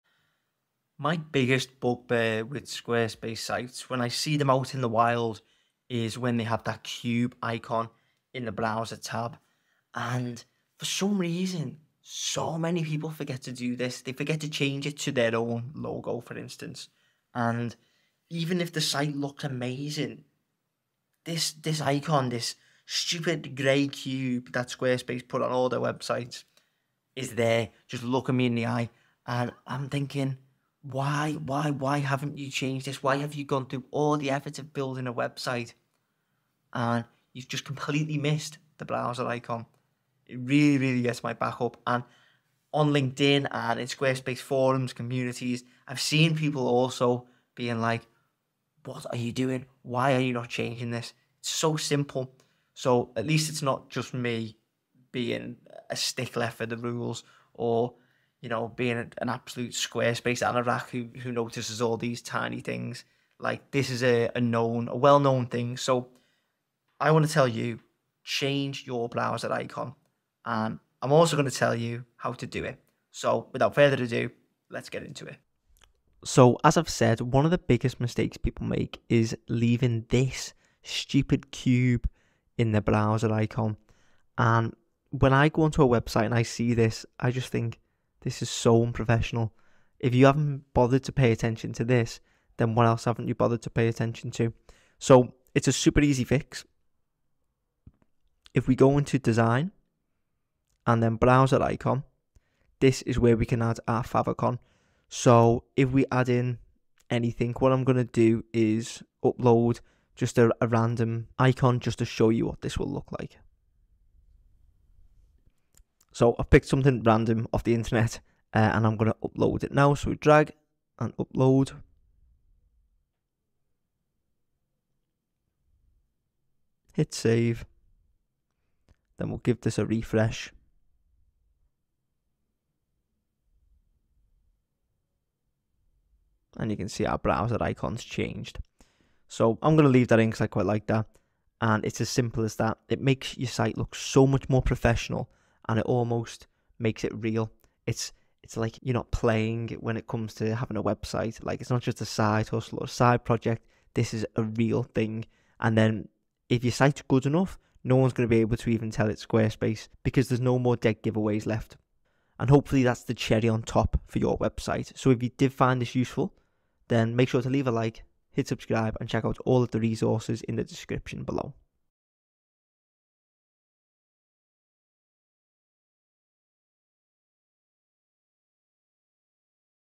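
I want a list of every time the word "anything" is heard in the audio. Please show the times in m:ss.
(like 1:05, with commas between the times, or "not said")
1:47.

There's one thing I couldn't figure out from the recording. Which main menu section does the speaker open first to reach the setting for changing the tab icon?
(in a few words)
Design.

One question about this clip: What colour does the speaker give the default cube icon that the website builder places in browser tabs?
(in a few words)
grey.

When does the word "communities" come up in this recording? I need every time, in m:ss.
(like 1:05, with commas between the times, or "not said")
0:44.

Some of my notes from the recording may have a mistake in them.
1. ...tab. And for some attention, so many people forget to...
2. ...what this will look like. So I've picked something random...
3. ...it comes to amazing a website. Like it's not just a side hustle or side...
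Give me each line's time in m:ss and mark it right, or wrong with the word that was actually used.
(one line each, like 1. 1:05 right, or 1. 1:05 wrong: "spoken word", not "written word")
1. 0:08 wrong: "reason", not "attention"
2. 1:52 right
3. 2:29 wrong: "having", not "amazing".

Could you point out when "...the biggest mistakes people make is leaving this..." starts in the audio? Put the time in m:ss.
1:17.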